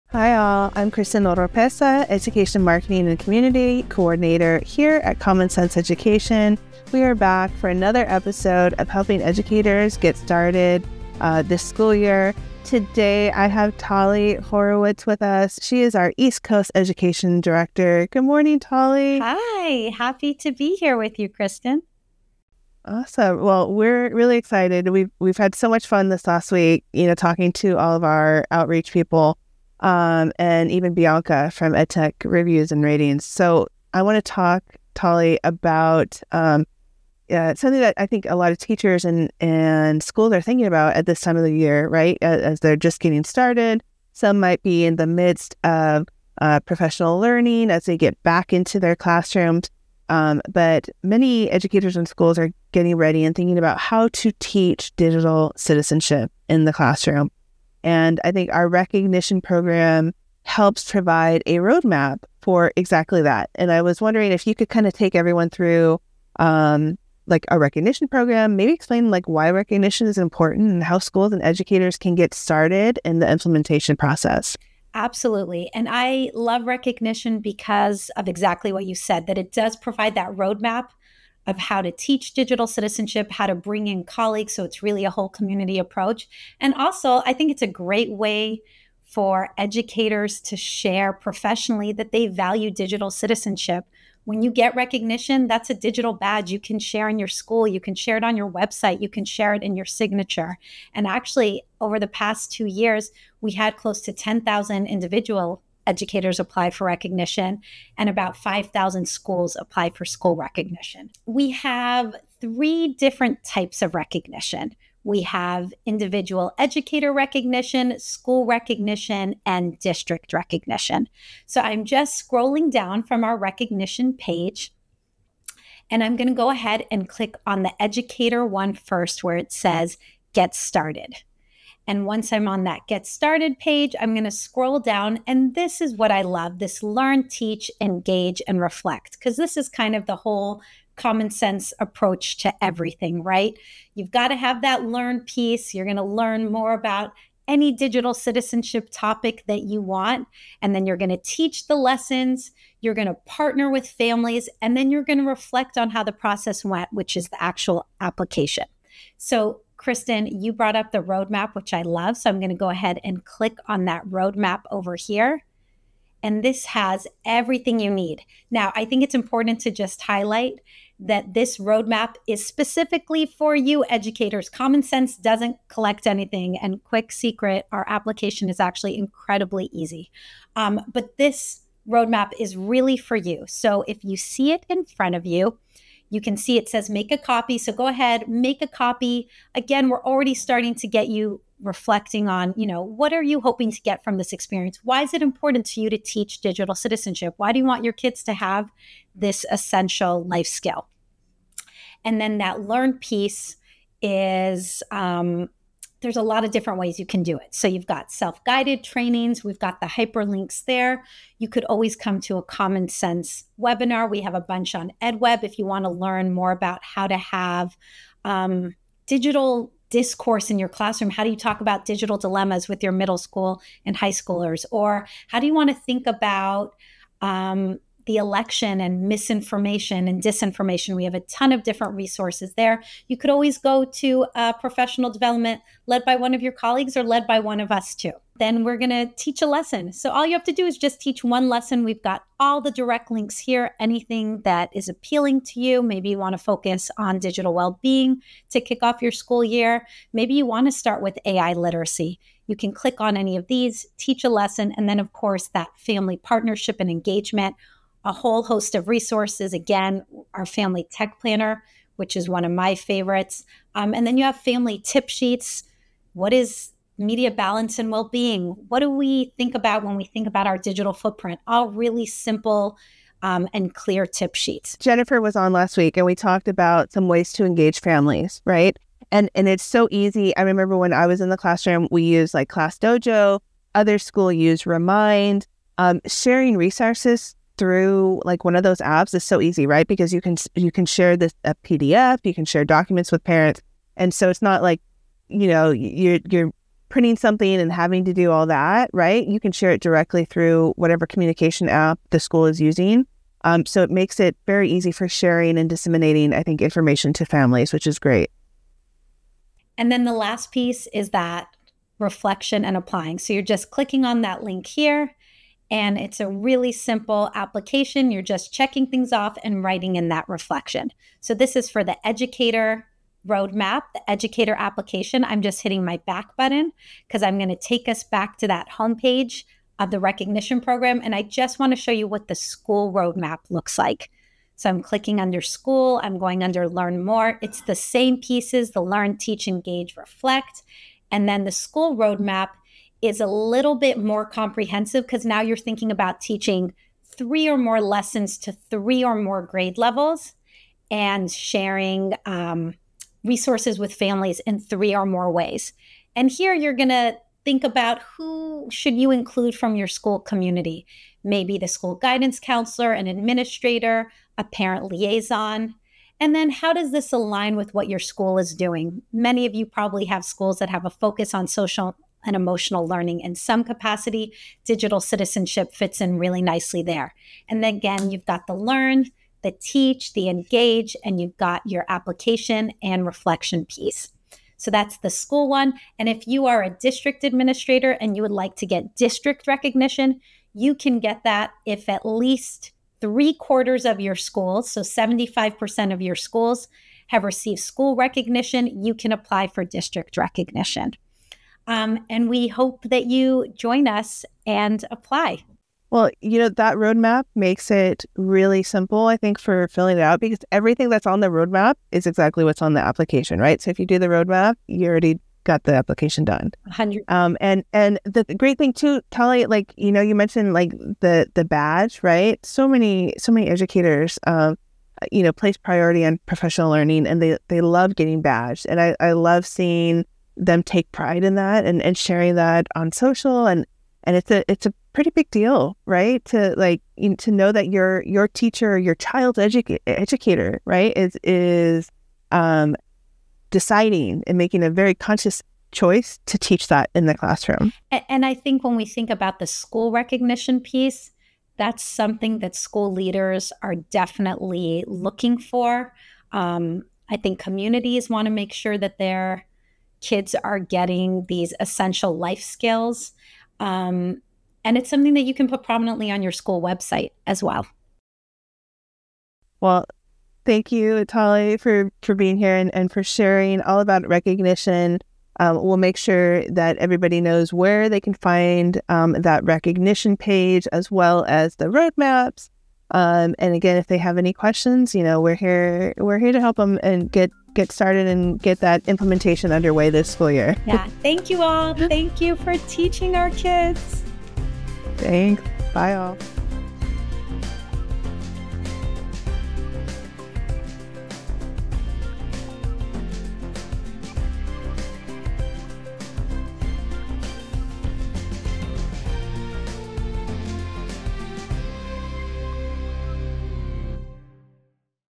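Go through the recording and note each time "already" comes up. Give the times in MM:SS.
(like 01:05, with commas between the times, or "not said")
03:10, 06:54.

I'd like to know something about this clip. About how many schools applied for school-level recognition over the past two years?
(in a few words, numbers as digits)
5,000.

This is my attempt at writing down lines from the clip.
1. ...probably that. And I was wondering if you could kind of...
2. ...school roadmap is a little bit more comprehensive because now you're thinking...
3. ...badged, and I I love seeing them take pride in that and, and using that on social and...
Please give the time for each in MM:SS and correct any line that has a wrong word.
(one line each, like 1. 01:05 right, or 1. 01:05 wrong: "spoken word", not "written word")
1. 01:02 wrong: "exactly", not "probably"
2. 05:41 right
3. 07:08 wrong: "sharing", not "using".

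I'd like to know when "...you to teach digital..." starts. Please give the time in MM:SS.
03:15.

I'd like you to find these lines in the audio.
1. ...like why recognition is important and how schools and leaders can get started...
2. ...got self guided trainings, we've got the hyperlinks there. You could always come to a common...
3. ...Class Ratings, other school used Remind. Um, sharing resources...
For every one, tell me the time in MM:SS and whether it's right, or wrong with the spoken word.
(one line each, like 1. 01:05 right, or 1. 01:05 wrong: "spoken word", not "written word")
1. 01:09 wrong: "educators", not "leaders"
2. 03:27 right
3. 04:42 wrong: "Dojo", not "Ratings".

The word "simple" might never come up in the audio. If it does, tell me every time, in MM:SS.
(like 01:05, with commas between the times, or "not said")
04:32, 05:16, 06:48.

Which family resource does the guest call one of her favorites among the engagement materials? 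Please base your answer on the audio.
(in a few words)
family tech planner.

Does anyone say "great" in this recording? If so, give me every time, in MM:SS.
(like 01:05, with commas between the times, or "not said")
01:27, 05:07, 06:58.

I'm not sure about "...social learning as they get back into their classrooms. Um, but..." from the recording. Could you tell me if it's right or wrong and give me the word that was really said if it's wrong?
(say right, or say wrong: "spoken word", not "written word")
wrong: "professional", not "social".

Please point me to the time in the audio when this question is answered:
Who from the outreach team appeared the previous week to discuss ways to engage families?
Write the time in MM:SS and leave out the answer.
04:34.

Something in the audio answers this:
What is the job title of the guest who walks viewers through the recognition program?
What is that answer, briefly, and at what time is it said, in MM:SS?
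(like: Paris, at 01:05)
East Coast Education Director, at 00:16.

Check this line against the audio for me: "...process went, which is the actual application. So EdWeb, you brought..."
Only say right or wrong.
wrong.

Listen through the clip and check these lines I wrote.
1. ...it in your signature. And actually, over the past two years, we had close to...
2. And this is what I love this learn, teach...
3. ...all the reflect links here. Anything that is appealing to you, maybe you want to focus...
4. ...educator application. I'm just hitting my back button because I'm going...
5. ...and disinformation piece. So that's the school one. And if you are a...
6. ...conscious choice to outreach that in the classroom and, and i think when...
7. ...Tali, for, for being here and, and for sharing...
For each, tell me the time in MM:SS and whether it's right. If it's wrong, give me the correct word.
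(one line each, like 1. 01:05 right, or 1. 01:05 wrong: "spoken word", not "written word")
1. 01:39 right
2. 02:15 right
3. 04:02 wrong: "direct", not "reflect"
4. 05:24 right
5. 06:22 wrong: "reflection", not "disinformation"
6. 07:24 wrong: "teach", not "outreach"
7. 07:51 right.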